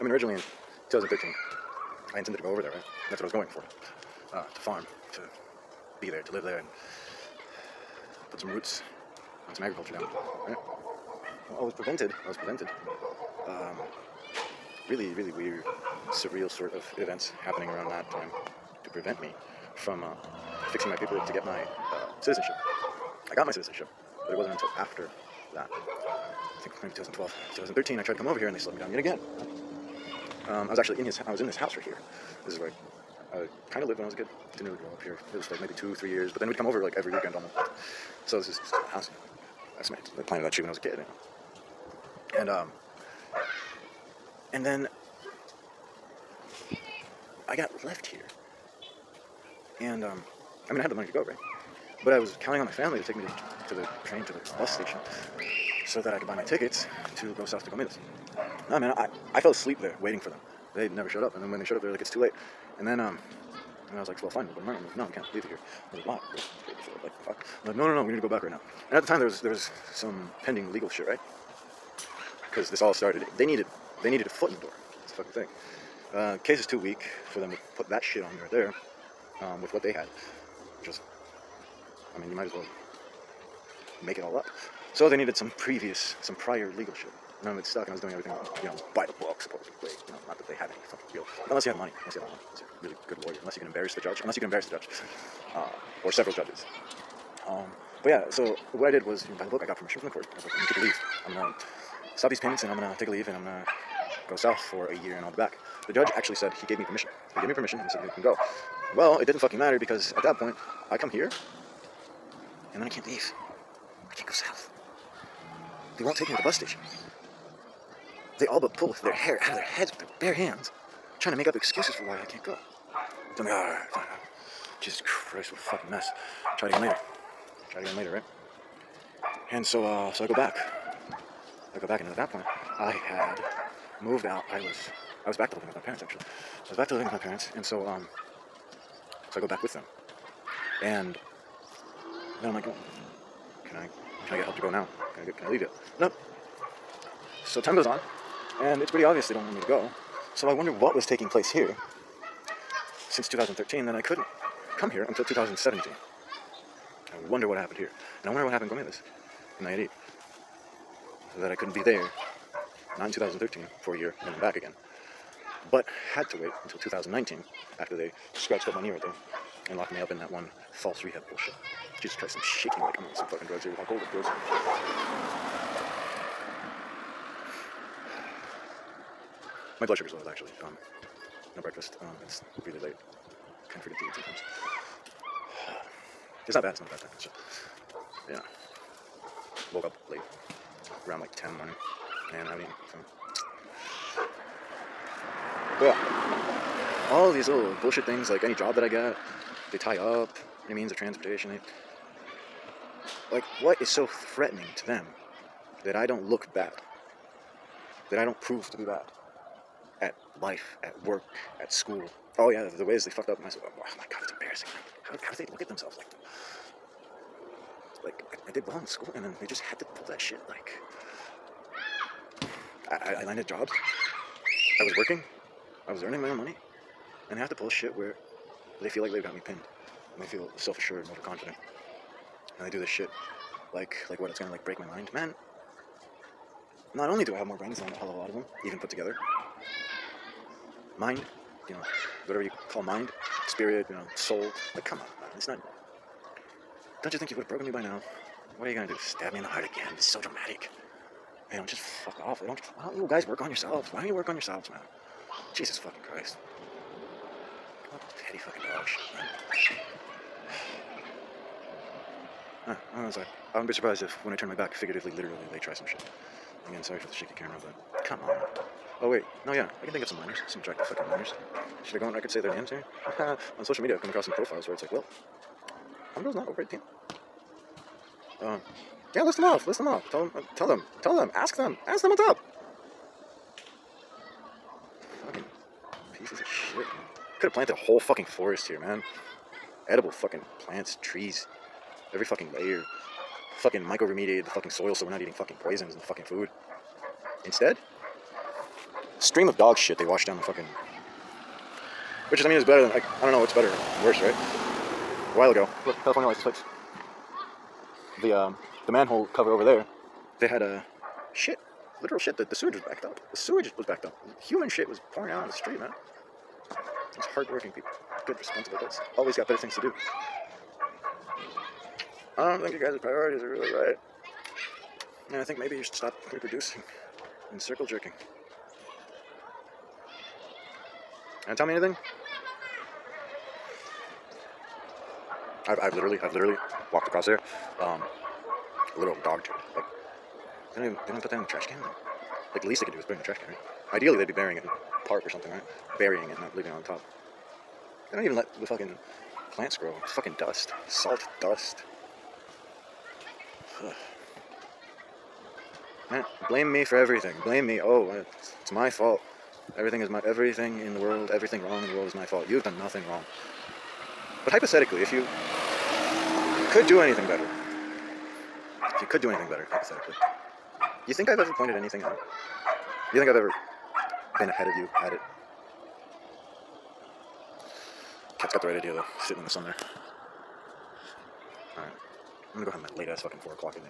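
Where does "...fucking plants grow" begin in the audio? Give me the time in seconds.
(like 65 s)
348 s.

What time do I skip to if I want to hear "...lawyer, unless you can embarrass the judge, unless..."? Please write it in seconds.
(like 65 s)
93 s.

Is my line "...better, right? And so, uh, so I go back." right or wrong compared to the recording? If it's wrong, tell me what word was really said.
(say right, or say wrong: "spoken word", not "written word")
wrong: "later", not "better".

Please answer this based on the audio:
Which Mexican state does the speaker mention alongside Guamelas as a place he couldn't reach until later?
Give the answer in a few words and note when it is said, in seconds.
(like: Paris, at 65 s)
Nayarit, at 159 s.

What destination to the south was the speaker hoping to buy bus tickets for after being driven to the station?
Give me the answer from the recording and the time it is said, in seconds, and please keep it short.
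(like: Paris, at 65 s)
Comidas, at 57 s.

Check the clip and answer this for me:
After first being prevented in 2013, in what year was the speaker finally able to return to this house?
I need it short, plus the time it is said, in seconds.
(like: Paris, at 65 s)
2017, at 155 s.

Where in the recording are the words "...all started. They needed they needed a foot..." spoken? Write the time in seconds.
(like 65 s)
72 s.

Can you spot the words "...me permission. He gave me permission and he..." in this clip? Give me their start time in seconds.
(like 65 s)
106 s.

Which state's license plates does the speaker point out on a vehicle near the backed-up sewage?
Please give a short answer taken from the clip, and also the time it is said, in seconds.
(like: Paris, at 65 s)
California, at 306 s.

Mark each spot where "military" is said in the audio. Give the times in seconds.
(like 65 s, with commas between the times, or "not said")
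not said.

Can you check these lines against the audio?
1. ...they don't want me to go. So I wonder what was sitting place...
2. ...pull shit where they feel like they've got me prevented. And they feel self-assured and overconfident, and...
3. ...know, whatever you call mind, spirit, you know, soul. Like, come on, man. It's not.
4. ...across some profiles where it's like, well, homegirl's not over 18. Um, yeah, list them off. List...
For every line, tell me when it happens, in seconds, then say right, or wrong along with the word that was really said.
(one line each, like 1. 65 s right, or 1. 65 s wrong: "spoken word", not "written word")
1. 149 s wrong: "taking", not "sitting"
2. 227 s wrong: "pinned", not "prevented"
3. 241 s right
4. 274 s right.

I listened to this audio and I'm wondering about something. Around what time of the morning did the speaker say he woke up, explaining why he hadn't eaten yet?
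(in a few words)
10.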